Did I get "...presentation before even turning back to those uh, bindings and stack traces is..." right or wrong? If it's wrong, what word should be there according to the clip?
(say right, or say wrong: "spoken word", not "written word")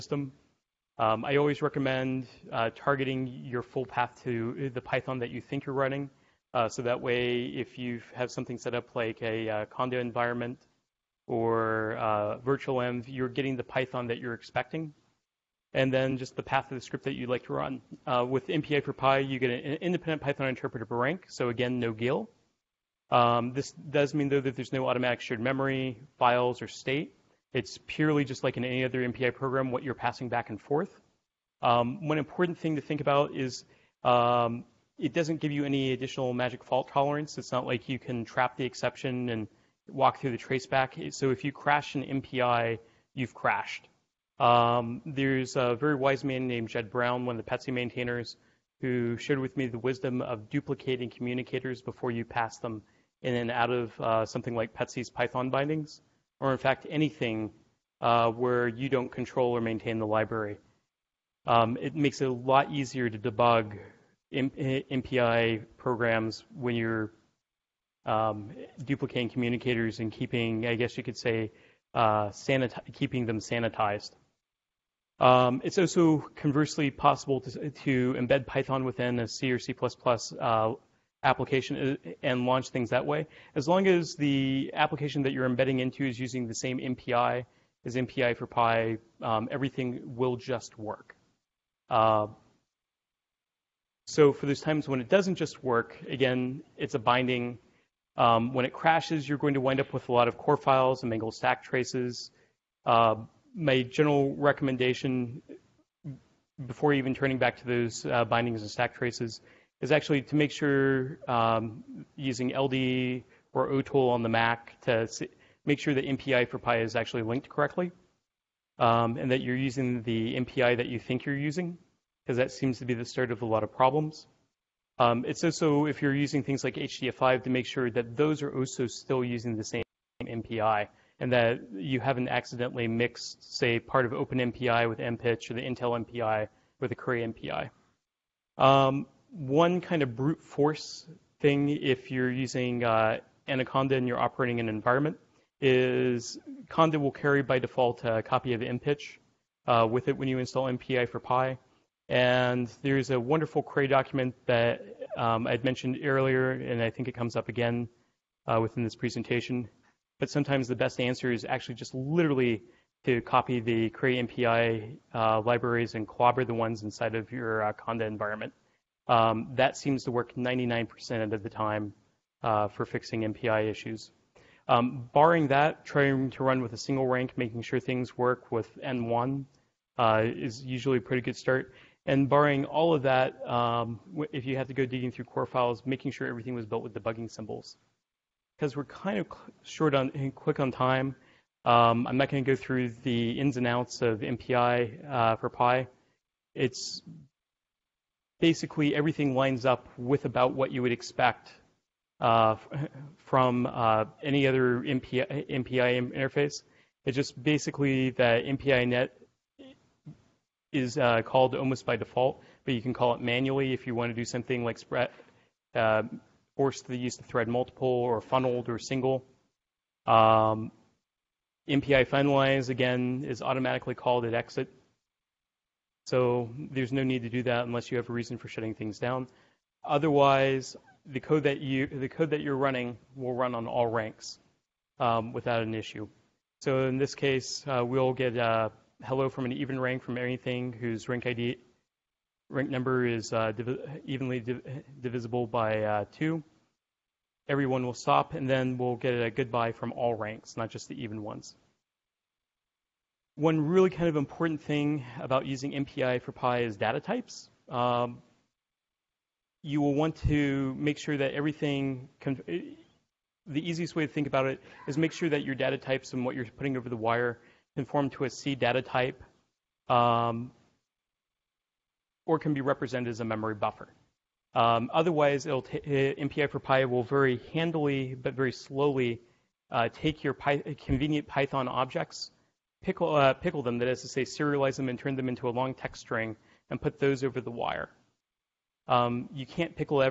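wrong: "recommendation", not "presentation".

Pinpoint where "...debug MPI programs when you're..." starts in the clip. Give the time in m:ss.
1:03.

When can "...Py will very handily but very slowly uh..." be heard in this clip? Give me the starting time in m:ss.
4:36.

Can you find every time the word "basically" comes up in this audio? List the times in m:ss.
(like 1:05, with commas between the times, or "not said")
3:18, 3:27.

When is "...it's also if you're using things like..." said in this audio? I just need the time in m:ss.
2:05.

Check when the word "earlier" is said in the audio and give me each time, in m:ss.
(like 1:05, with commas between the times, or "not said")
2:36.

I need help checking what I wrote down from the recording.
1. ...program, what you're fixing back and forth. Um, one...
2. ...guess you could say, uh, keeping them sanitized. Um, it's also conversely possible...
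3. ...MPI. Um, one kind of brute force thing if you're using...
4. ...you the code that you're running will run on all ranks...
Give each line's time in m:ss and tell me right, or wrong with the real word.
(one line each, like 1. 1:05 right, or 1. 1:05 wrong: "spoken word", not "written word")
1. 0:29 wrong: "passing", not "fixing"
2. 1:10 right
3. 2:17 right
4. 3:51 right.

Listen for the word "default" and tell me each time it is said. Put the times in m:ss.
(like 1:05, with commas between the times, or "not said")
2:27, 3:31.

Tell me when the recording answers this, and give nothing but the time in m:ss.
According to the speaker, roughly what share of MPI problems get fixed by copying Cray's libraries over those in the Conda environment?
2:50.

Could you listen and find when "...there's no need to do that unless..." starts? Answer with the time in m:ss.
3:46.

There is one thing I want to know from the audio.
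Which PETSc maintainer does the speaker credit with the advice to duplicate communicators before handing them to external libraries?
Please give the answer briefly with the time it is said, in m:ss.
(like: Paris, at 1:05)
Jed Brown, at 0:46.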